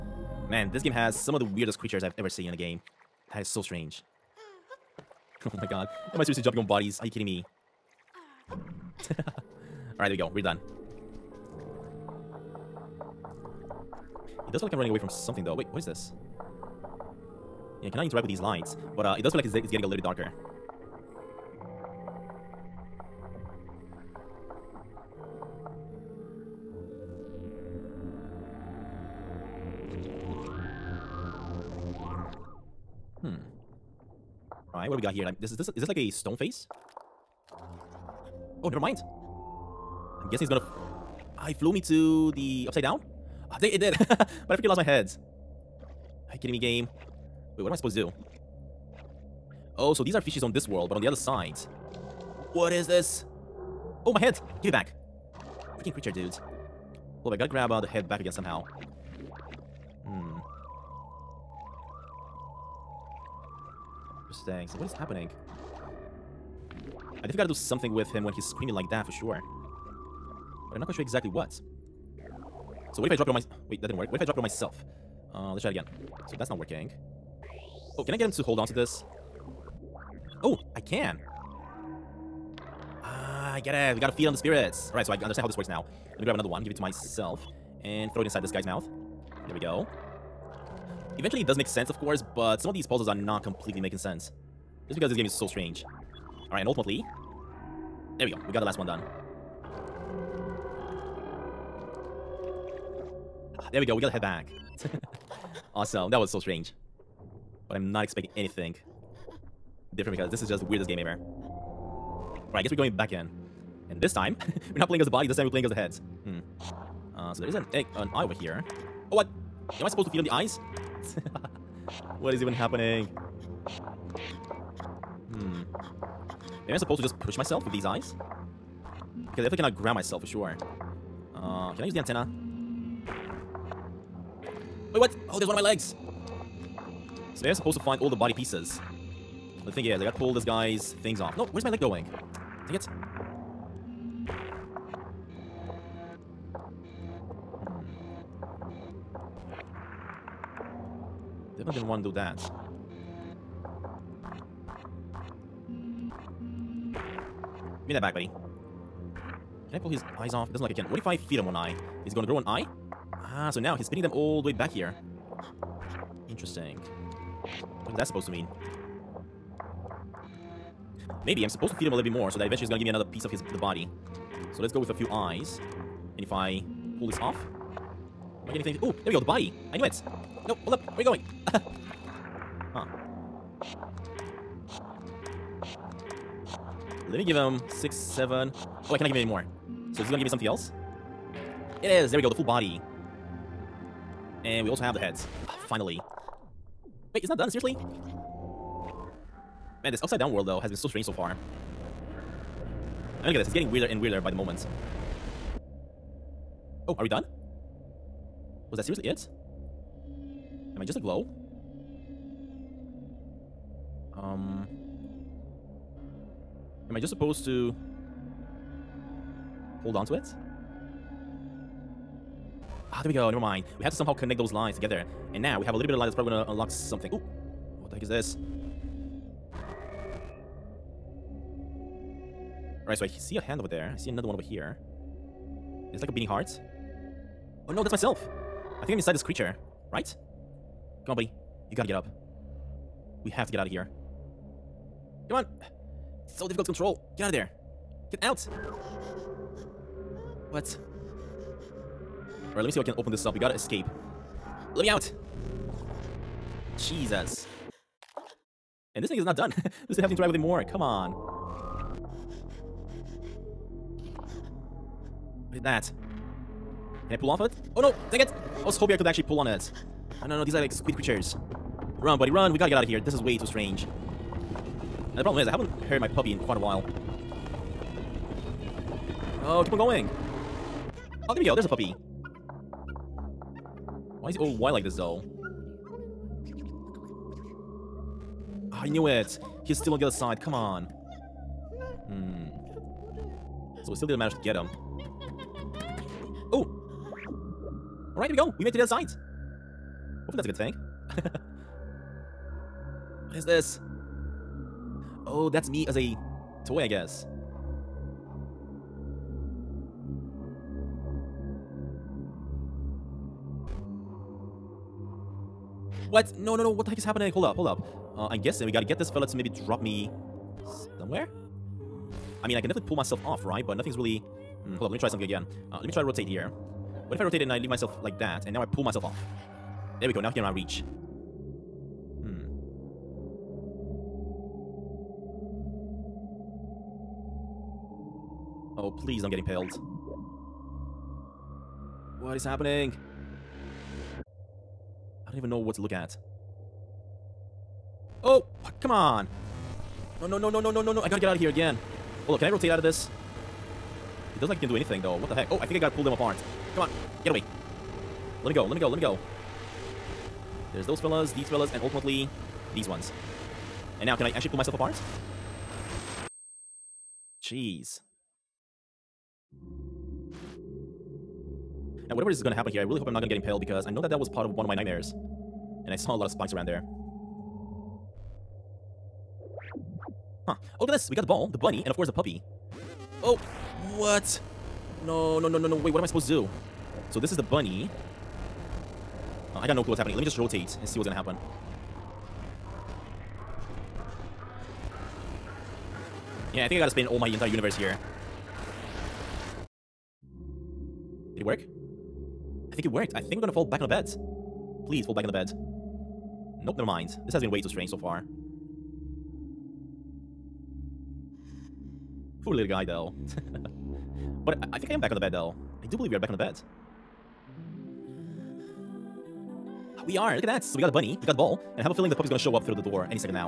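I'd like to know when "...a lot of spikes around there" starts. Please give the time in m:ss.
6:16.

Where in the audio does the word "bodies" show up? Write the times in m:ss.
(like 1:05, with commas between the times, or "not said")
0:06.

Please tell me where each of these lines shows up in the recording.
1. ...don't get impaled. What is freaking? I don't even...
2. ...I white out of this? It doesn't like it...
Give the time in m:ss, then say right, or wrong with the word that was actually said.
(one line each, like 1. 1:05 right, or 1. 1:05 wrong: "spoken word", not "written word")
1. 5:39 wrong: "happening", not "freaking"
2. 5:52 wrong: "rotate", not "white".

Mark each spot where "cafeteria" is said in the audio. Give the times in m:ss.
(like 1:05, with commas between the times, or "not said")
not said.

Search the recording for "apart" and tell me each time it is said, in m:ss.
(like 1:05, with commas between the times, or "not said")
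5:56, 6:04.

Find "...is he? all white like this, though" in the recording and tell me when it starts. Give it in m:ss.
4:44.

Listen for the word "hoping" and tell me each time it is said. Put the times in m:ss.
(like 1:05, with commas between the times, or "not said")
4:28.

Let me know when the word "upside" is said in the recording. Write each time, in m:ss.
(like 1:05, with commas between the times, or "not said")
0:42, 3:20.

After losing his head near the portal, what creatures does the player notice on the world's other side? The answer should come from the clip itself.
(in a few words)
fishes.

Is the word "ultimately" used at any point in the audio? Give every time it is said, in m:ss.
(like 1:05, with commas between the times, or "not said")
1:36, 6:01.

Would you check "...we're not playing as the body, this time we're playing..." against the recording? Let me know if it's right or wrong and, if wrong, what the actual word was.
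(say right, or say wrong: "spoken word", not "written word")
right.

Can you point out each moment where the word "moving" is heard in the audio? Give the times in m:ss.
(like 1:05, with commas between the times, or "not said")
not said.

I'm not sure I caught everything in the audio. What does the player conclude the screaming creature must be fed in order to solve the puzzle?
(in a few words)
the spirits.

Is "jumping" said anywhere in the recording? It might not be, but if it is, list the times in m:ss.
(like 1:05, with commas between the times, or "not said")
0:06.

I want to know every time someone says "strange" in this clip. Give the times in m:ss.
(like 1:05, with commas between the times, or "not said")
0:03, 1:35, 1:46, 3:20, 4:33, 6:47.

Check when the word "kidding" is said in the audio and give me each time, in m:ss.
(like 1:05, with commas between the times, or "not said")
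0:07, 0:46.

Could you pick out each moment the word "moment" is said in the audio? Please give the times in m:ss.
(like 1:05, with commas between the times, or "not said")
3:24.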